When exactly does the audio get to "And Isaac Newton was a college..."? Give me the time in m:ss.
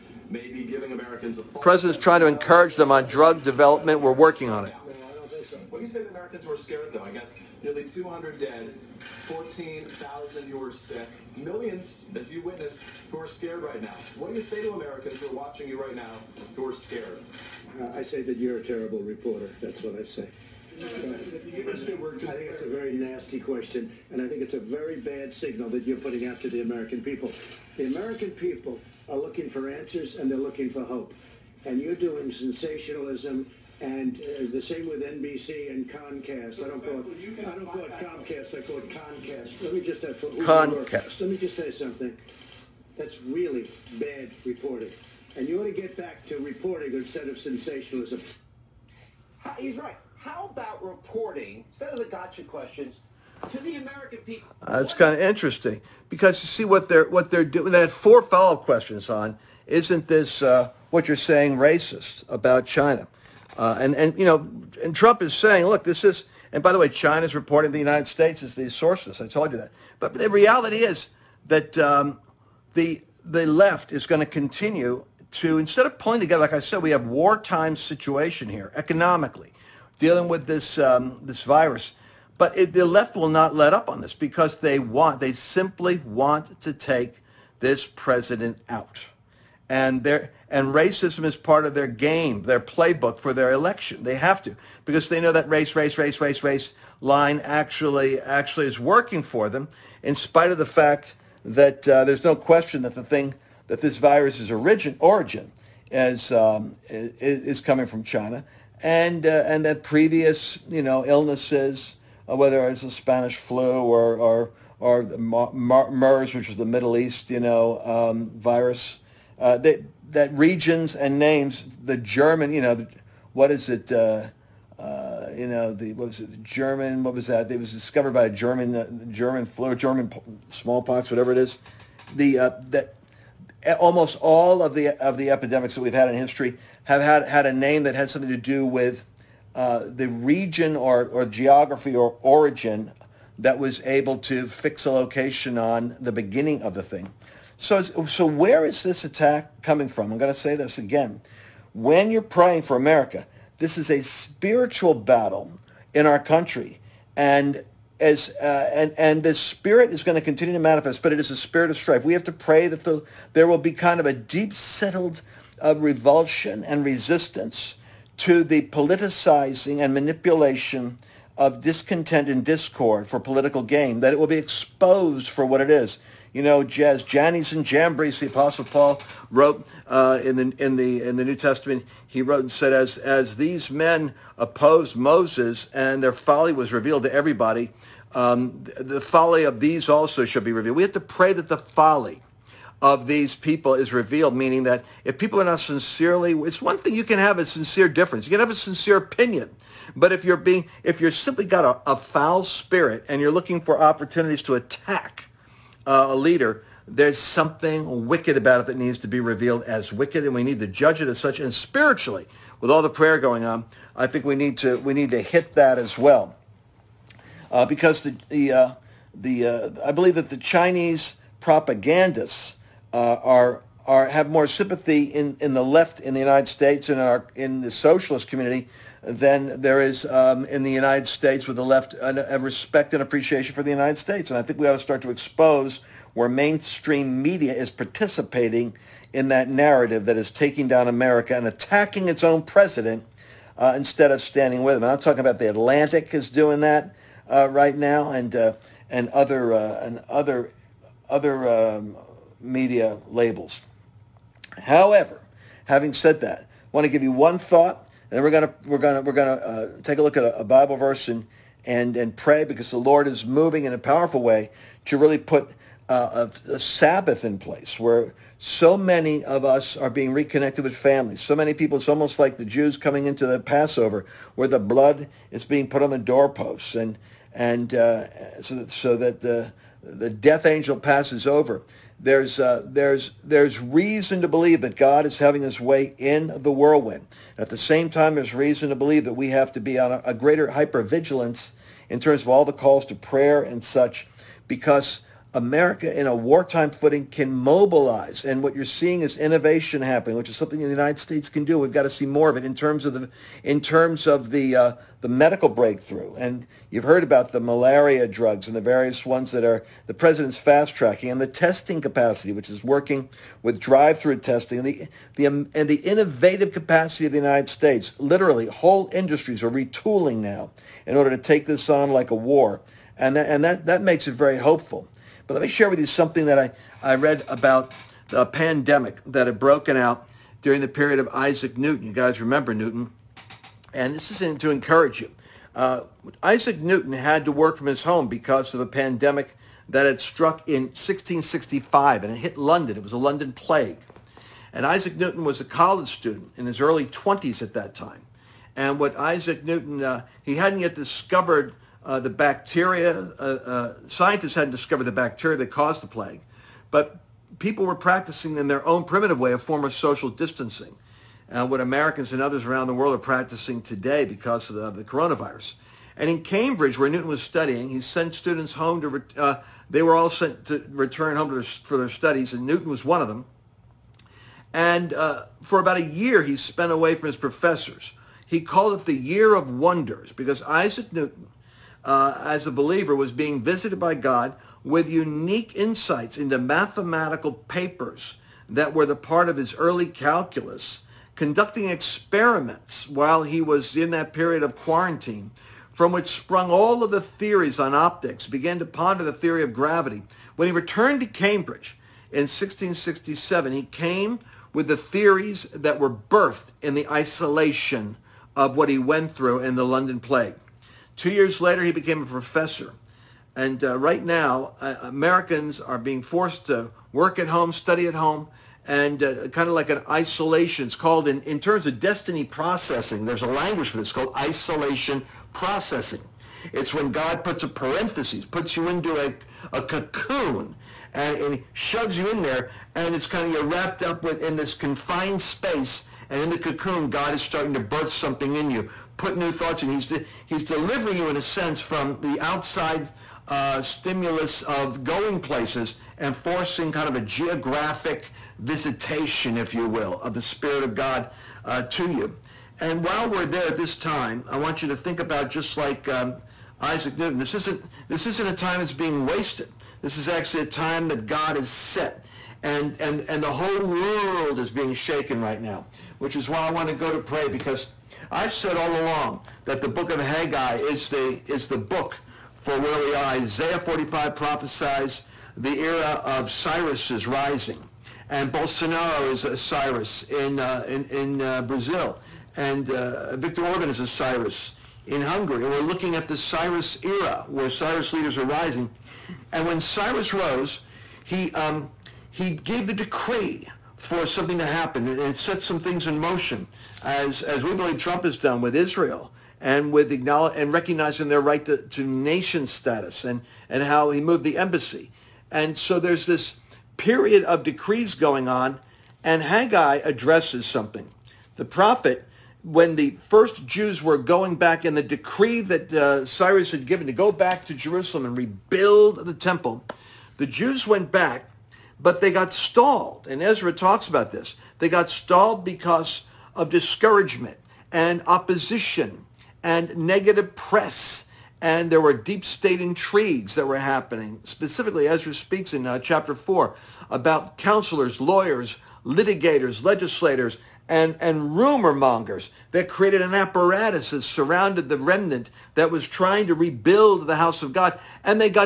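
5:44.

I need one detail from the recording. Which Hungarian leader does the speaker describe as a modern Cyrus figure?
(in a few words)
Viktor Orban.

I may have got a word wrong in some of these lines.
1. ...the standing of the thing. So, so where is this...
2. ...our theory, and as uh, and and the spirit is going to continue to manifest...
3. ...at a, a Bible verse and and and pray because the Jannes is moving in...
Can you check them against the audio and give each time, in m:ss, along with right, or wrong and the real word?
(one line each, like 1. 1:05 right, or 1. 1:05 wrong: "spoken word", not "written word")
1. 2:25 wrong: "beginning", not "standing"
2. 2:36 wrong: "country", not "theory"
3. 4:20 wrong: "Lord", not "Jannes".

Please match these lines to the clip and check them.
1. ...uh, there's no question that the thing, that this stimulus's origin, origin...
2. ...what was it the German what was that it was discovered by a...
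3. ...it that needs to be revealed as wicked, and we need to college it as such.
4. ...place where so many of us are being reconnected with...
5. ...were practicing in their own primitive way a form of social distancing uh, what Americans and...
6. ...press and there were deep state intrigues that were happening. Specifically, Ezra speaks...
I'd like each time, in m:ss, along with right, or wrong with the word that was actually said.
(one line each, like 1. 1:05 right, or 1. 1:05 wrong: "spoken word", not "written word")
1. 1:41 wrong: "virus", not "stimulus"
2. 2:05 right
3. 3:28 wrong: "judge", not "college"
4. 4:27 right
5. 5:57 right
6. 8:50 right.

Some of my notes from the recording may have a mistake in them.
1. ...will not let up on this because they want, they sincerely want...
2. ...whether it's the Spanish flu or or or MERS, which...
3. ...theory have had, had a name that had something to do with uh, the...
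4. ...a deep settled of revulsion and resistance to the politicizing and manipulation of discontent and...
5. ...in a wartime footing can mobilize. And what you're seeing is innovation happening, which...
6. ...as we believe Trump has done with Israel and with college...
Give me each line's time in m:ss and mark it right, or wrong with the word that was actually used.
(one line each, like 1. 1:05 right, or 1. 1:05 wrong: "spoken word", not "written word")
1. 1:23 wrong: "simply", not "sincerely"
2. 1:52 right
3. 2:16 wrong: "history", not "theory"
4. 2:44 right
5. 4:55 right
6. 8:17 wrong: "acknowledge", not "college".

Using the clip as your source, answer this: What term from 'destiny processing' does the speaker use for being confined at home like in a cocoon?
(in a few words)
isolation processing.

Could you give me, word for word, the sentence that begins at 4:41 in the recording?
There's, uh, there's, there's reason to believe that God is having his way in the whirlwind.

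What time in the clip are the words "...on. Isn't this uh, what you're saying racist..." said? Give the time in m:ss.
0:59.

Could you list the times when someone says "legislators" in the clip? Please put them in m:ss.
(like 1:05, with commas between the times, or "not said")
8:59.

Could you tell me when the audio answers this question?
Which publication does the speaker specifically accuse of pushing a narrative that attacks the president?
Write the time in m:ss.
4:05.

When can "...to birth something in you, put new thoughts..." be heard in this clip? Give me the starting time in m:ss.
7:17.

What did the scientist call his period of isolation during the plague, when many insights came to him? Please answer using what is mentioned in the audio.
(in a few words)
the Year of Wonders.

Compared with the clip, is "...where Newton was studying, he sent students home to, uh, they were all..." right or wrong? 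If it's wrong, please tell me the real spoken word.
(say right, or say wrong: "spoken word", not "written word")
right.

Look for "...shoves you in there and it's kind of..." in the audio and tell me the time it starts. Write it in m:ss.
7:11.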